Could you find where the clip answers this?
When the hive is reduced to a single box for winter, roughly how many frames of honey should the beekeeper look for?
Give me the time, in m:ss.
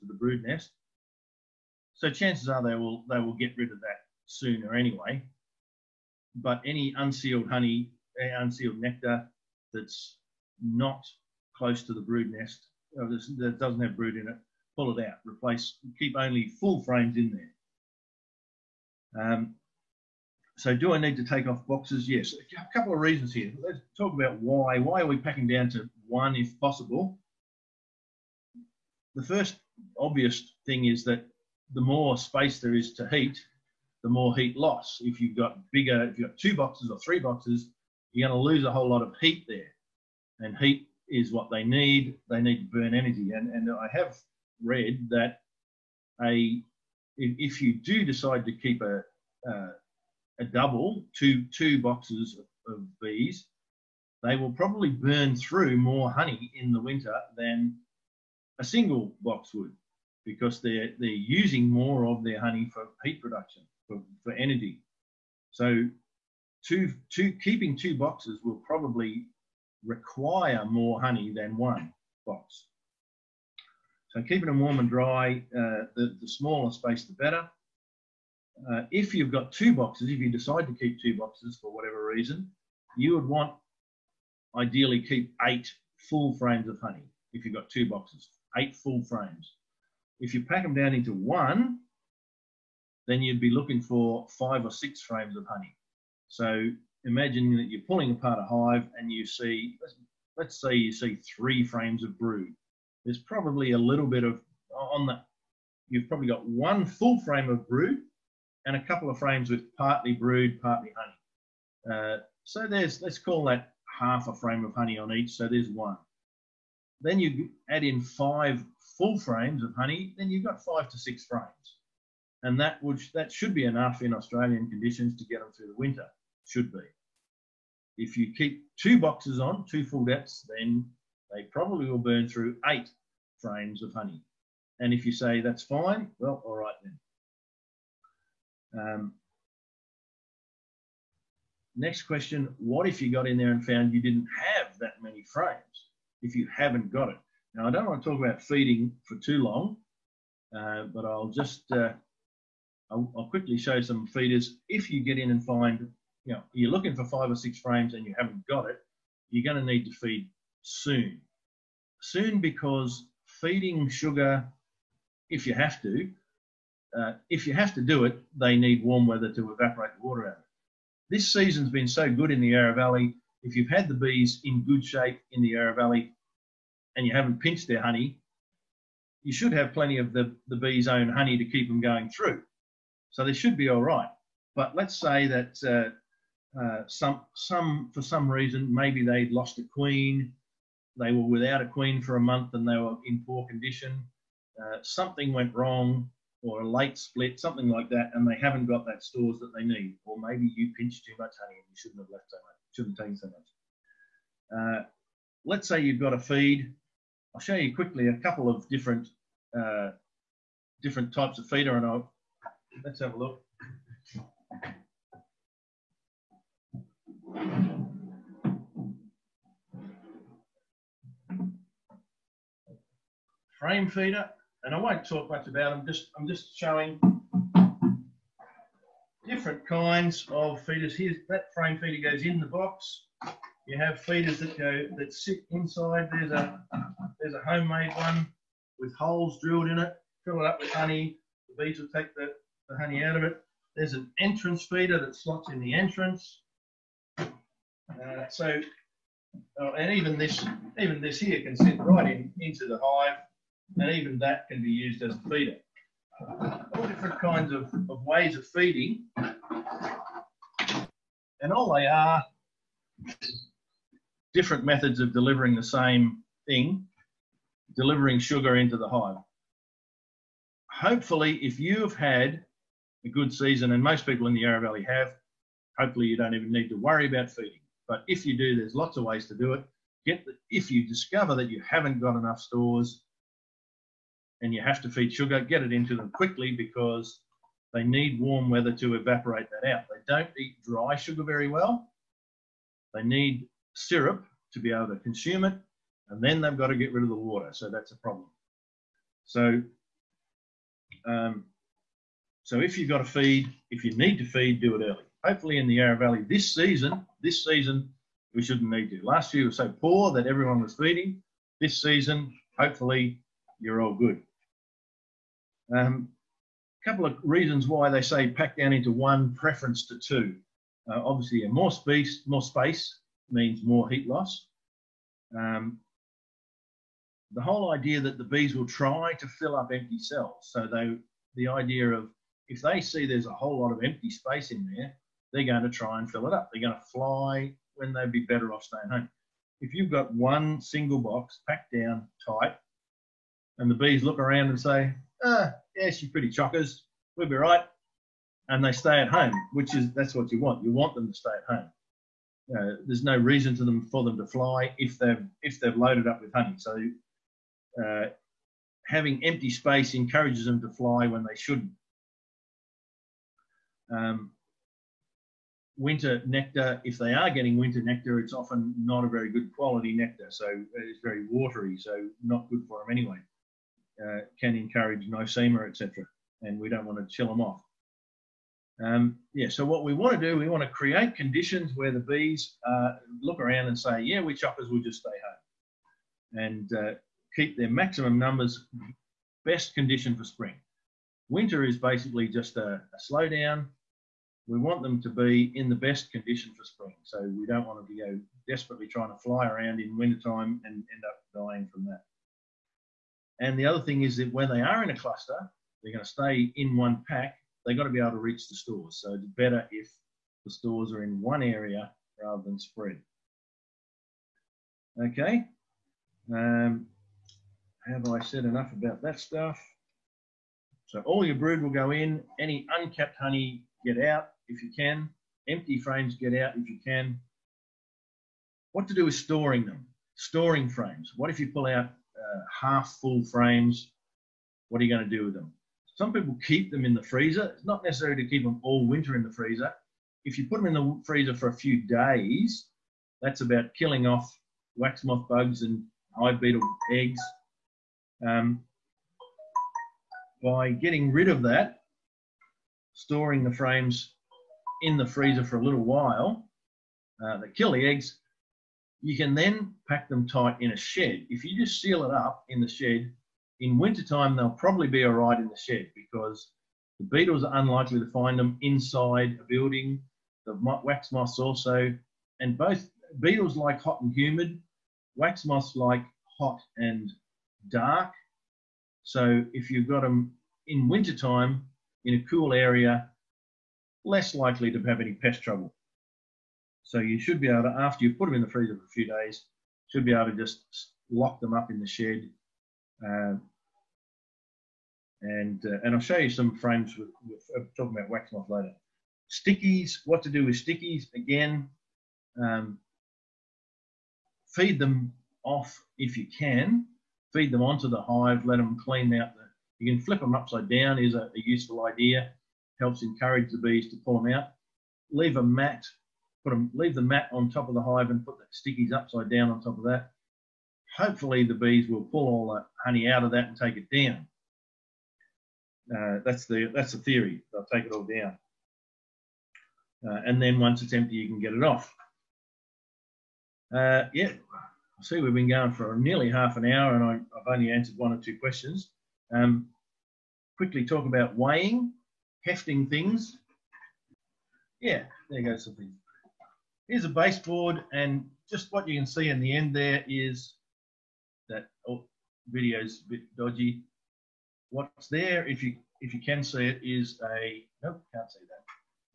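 1:34.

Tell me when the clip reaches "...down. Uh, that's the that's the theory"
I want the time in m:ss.
8:43.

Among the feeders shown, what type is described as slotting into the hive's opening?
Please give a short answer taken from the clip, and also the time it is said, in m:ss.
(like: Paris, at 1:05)
Entrance feeder, at 4:04.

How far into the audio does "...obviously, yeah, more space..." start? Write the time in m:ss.
5:21.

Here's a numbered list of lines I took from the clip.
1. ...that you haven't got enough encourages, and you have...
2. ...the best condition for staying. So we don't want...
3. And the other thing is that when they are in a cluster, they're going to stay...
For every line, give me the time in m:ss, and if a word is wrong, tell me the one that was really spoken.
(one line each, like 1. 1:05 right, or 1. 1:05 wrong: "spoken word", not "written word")
1. 4:41 wrong: "stores", not "encourages"
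2. 6:35 wrong: "spring", not "staying"
3. 6:43 right.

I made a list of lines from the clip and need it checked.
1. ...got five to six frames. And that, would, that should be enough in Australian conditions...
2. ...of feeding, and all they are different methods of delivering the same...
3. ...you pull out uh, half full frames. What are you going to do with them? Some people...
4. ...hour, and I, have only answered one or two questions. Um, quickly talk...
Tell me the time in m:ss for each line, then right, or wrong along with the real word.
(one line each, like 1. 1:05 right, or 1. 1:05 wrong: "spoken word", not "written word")
1. 2:00 right
2. 4:18 right
3. 7:11 right
4. 8:56 right.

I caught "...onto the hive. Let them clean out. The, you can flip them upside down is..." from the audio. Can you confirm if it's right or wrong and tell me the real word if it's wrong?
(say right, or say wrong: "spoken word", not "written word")
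right.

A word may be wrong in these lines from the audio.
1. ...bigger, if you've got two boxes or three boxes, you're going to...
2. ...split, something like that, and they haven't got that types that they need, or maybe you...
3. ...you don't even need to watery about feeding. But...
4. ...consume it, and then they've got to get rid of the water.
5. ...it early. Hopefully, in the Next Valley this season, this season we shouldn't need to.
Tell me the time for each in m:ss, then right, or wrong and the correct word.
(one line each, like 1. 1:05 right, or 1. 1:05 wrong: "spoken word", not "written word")
1. 0:35 right
2. 3:16 wrong: "stores", not "types"
3. 4:36 wrong: "worry", not "watery"
4. 4:54 right
5. 5:04 wrong: "Yarra", not "Next".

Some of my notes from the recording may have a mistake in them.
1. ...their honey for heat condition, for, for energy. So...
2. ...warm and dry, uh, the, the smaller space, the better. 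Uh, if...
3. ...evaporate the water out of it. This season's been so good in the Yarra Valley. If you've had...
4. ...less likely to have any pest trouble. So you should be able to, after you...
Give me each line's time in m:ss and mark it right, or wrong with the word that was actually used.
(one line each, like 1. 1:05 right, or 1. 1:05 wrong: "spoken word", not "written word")
1. 1:02 wrong: "production", not "condition"
2. 1:14 right
3. 2:49 right
4. 8:04 right.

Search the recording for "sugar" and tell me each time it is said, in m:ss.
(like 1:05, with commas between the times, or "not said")
2:43, 4:28, 4:45, 4:50.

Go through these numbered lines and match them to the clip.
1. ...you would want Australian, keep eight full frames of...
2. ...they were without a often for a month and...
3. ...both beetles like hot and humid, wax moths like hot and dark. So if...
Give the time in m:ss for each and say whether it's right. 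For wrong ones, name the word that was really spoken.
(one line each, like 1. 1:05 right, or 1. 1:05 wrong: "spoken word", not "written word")
1. 1:22 wrong: "Ideally", not "Australian"
2. 3:10 wrong: "queen", not "often"
3. 7:52 right.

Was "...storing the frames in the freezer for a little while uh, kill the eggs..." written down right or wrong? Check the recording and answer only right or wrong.
right.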